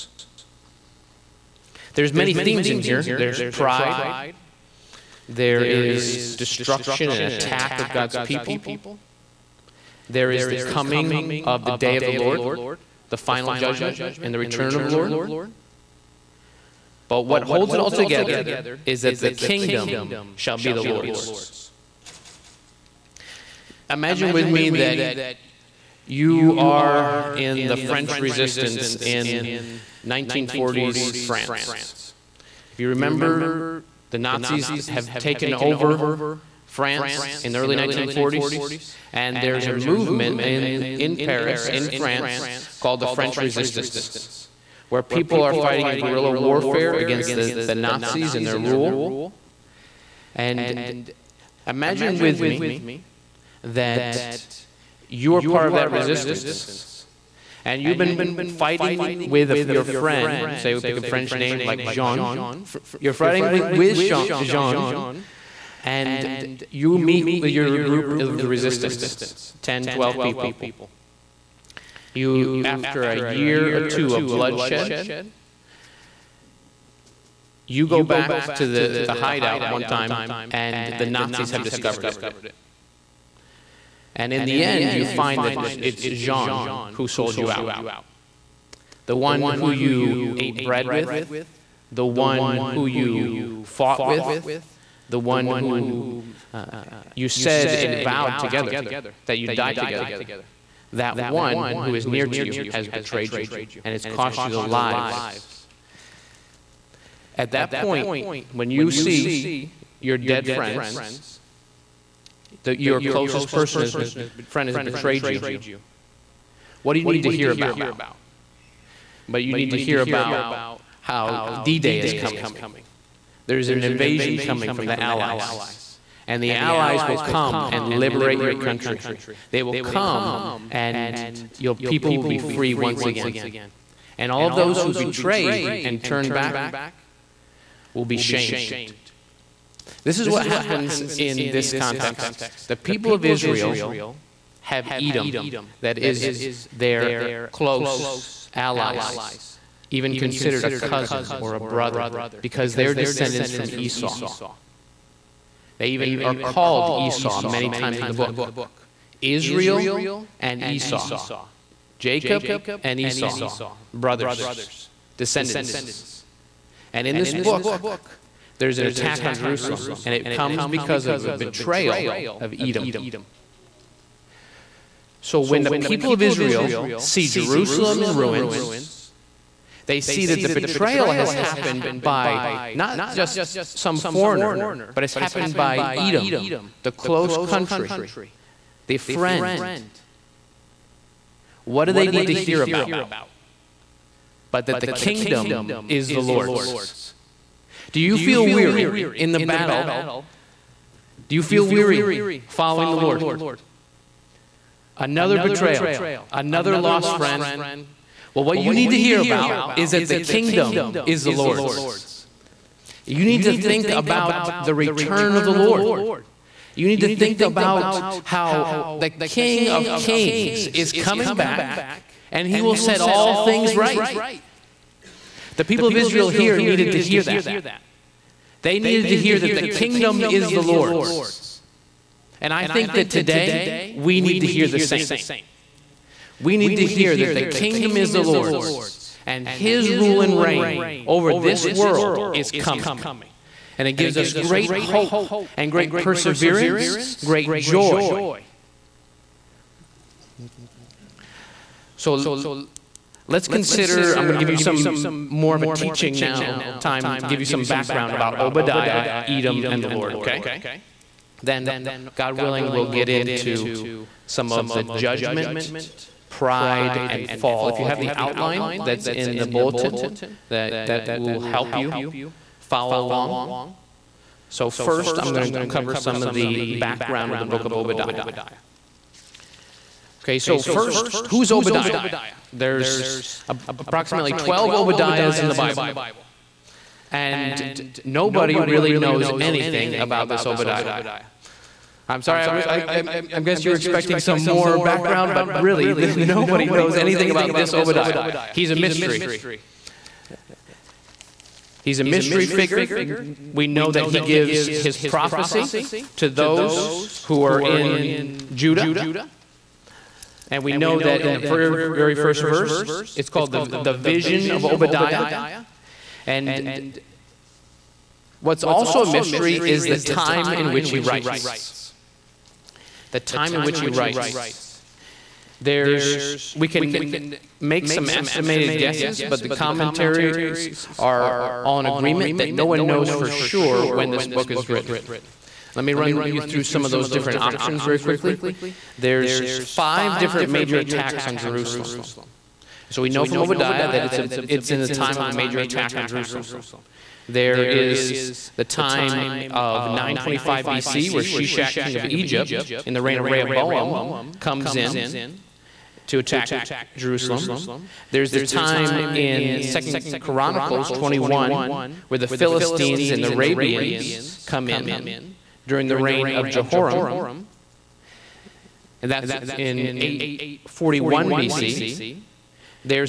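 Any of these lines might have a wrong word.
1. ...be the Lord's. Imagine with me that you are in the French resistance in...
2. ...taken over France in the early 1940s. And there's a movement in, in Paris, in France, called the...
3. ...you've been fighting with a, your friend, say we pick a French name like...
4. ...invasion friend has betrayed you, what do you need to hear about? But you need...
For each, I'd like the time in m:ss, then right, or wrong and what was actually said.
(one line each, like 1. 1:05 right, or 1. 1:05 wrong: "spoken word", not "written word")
1. 0:20 right
2. 0:35 right
3. 0:57 right
4. 1:53 wrong: "person", not "invasion".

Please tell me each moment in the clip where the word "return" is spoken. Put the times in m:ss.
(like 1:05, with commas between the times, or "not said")
0:14, 3:34.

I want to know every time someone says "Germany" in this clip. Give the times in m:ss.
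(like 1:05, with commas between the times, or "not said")
not said.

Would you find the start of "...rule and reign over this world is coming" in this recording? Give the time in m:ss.
3:59.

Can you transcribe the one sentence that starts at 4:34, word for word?
So, first, I'm going to cover some of the background of the book of Obadiah.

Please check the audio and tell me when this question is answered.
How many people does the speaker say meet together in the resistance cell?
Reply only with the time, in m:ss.
1:09.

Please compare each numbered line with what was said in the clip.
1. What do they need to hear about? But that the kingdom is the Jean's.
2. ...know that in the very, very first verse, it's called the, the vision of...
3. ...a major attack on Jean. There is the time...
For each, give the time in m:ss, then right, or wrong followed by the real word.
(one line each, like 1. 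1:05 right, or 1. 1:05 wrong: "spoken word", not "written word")
1. 3:11 wrong: "Lord", not "Jean"
2. 5:10 right
3. 5:45 wrong: "Jerusalem", not "Jean".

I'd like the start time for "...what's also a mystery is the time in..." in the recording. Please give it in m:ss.
5:18.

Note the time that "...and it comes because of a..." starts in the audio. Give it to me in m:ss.
2:50.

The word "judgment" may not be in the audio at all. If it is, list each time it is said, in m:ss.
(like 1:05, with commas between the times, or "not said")
0:13, 4:24.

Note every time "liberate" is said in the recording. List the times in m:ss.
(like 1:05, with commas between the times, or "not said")
2:07.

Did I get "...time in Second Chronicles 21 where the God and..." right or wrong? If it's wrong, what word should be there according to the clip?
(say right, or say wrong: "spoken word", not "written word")
wrong: "Philistines", not "God".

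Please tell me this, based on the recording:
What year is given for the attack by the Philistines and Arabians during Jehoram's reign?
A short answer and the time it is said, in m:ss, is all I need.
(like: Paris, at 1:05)
841 BC, at 6:09.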